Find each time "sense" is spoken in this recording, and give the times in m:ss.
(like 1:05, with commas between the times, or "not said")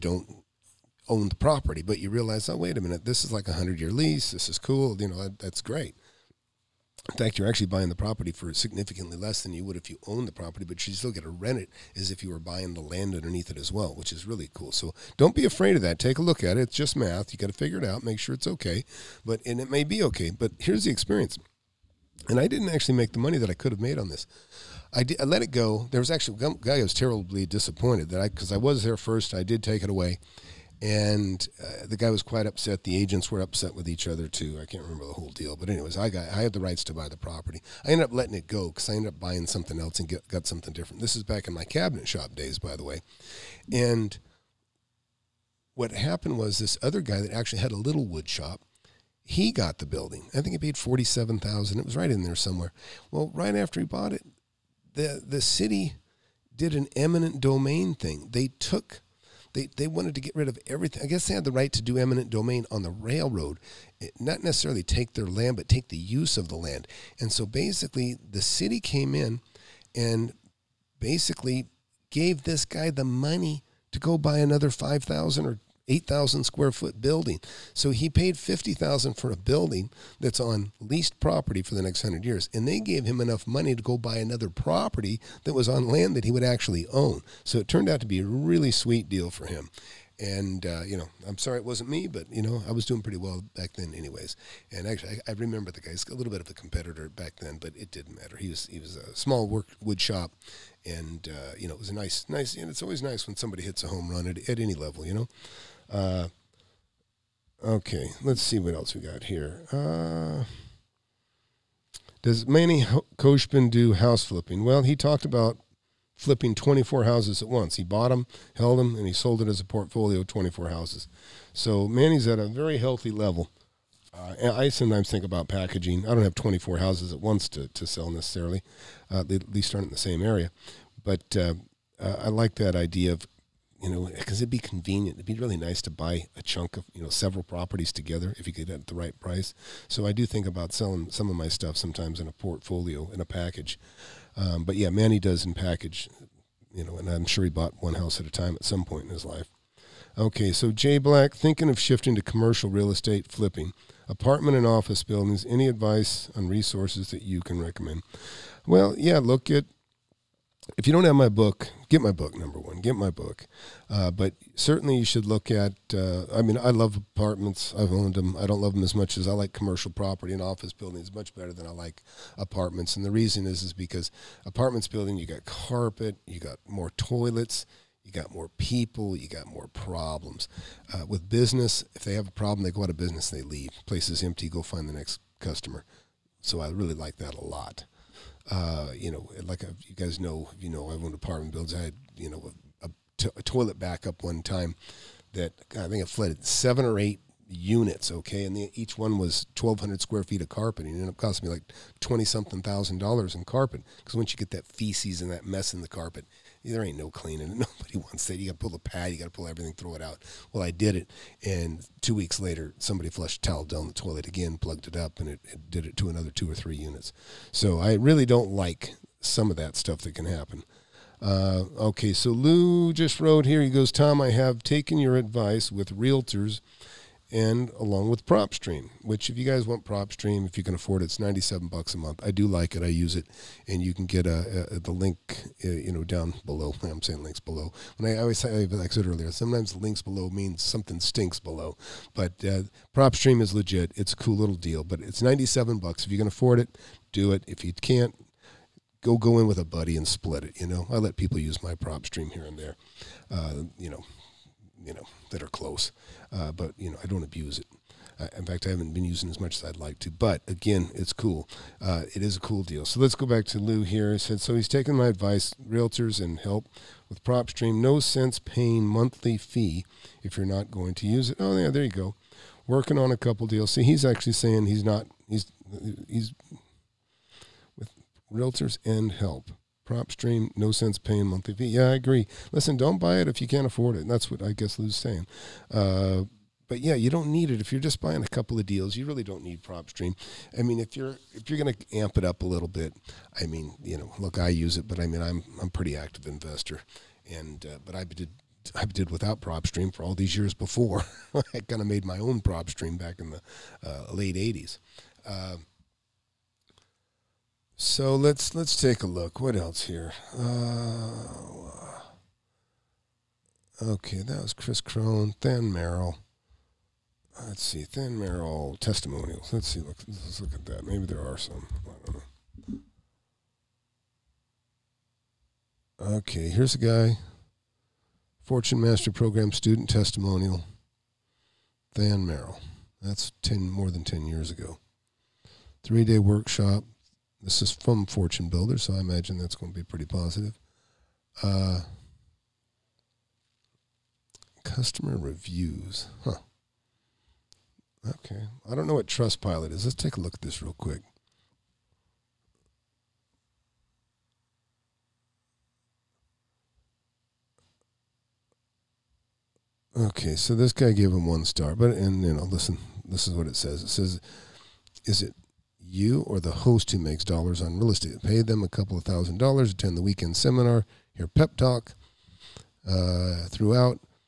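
4:27, 4:40.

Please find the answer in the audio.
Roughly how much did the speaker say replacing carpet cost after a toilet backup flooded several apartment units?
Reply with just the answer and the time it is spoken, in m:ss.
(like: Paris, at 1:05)
20 something thousand dollars, at 3:22.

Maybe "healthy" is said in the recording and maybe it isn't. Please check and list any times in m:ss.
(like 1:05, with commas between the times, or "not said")
2:02.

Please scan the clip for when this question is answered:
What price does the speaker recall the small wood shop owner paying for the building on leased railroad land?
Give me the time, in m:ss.
0:50.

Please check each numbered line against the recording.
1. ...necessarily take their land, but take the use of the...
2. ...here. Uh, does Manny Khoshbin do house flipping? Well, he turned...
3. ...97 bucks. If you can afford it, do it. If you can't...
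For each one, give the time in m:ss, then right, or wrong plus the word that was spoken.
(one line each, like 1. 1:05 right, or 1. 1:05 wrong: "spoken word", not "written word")
1. 1:04 right
2. 1:49 wrong: "talked", not "turned"
3. 4:05 right.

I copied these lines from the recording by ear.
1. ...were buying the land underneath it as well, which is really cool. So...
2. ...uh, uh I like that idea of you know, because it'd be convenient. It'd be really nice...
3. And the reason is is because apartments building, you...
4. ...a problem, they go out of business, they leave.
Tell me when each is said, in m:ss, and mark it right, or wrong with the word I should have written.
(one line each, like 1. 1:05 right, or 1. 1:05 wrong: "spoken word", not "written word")
1. 0:12 right
2. 2:11 right
3. 2:52 right
4. 3:02 right.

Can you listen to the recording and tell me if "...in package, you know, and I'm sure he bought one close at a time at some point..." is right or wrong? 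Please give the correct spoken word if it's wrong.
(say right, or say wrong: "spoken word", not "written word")
wrong: "house", not "close".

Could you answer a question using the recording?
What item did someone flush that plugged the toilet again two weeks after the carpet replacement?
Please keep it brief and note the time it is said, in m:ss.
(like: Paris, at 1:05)
A towel, at 3:33.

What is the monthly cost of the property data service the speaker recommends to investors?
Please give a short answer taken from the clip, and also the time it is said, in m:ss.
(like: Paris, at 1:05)
$97, at 3:51.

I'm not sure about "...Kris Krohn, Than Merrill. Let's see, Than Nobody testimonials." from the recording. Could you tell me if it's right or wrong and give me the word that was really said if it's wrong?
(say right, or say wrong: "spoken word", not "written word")
wrong: "Merrill", not "Nobody".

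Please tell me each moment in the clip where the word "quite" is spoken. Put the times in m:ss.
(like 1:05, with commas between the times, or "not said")
0:32.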